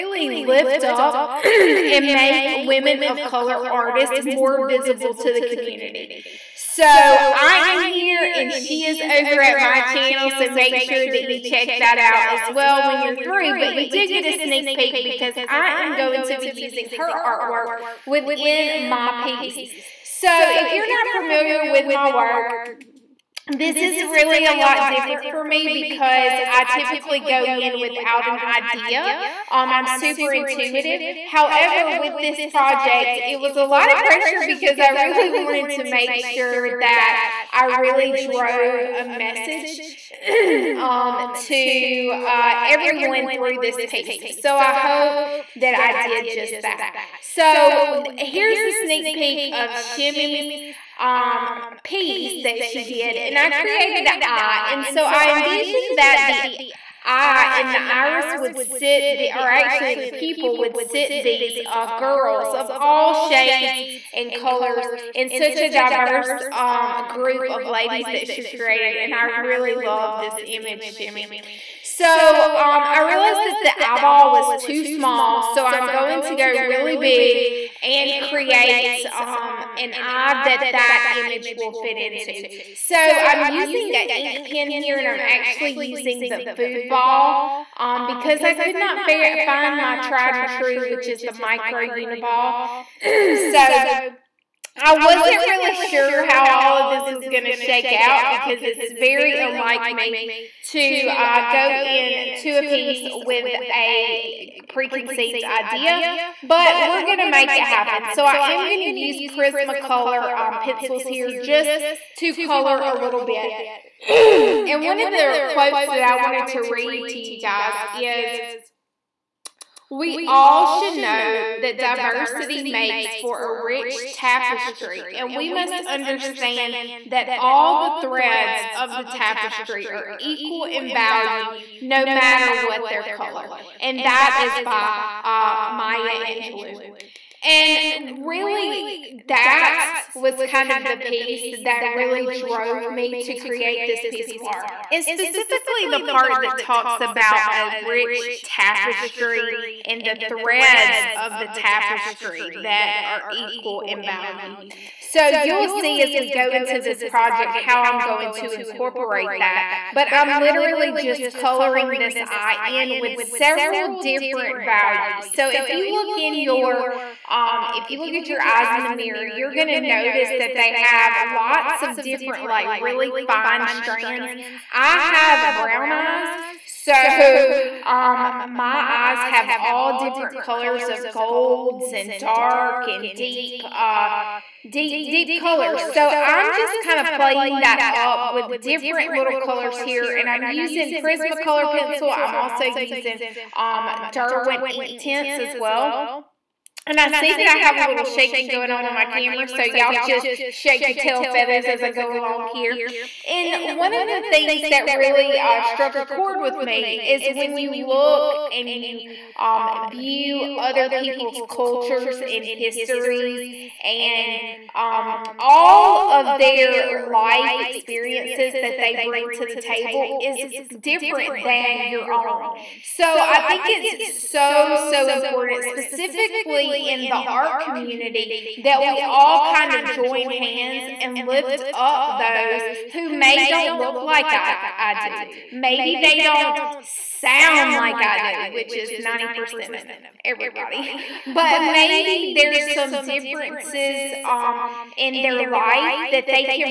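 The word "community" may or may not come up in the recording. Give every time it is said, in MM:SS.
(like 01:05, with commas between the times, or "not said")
00:05, 03:47.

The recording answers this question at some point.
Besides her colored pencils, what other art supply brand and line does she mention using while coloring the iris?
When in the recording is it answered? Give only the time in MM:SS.
03:14.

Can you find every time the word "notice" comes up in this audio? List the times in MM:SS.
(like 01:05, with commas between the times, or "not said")
02:50.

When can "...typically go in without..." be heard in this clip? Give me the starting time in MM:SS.
00:26.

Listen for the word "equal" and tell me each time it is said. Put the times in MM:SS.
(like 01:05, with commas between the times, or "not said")
02:10, 02:33.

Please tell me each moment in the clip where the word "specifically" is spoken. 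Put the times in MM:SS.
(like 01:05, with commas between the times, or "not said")
02:25, 03:45.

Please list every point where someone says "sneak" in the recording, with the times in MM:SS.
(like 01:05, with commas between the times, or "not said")
00:14, 00:48.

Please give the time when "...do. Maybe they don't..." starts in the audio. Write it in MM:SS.
03:54.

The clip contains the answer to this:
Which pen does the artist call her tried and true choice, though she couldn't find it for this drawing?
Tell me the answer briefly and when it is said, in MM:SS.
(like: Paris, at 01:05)
micro uniball, at 01:31.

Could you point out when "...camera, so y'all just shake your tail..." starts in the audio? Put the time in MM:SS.
03:19.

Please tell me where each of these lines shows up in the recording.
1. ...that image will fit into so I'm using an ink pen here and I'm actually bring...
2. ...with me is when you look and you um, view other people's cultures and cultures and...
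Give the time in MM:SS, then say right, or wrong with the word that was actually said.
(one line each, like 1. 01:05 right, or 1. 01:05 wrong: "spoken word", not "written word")
1. 01:20 wrong: "using", not "bring"
2. 03:26 wrong: "histories", not "cultures".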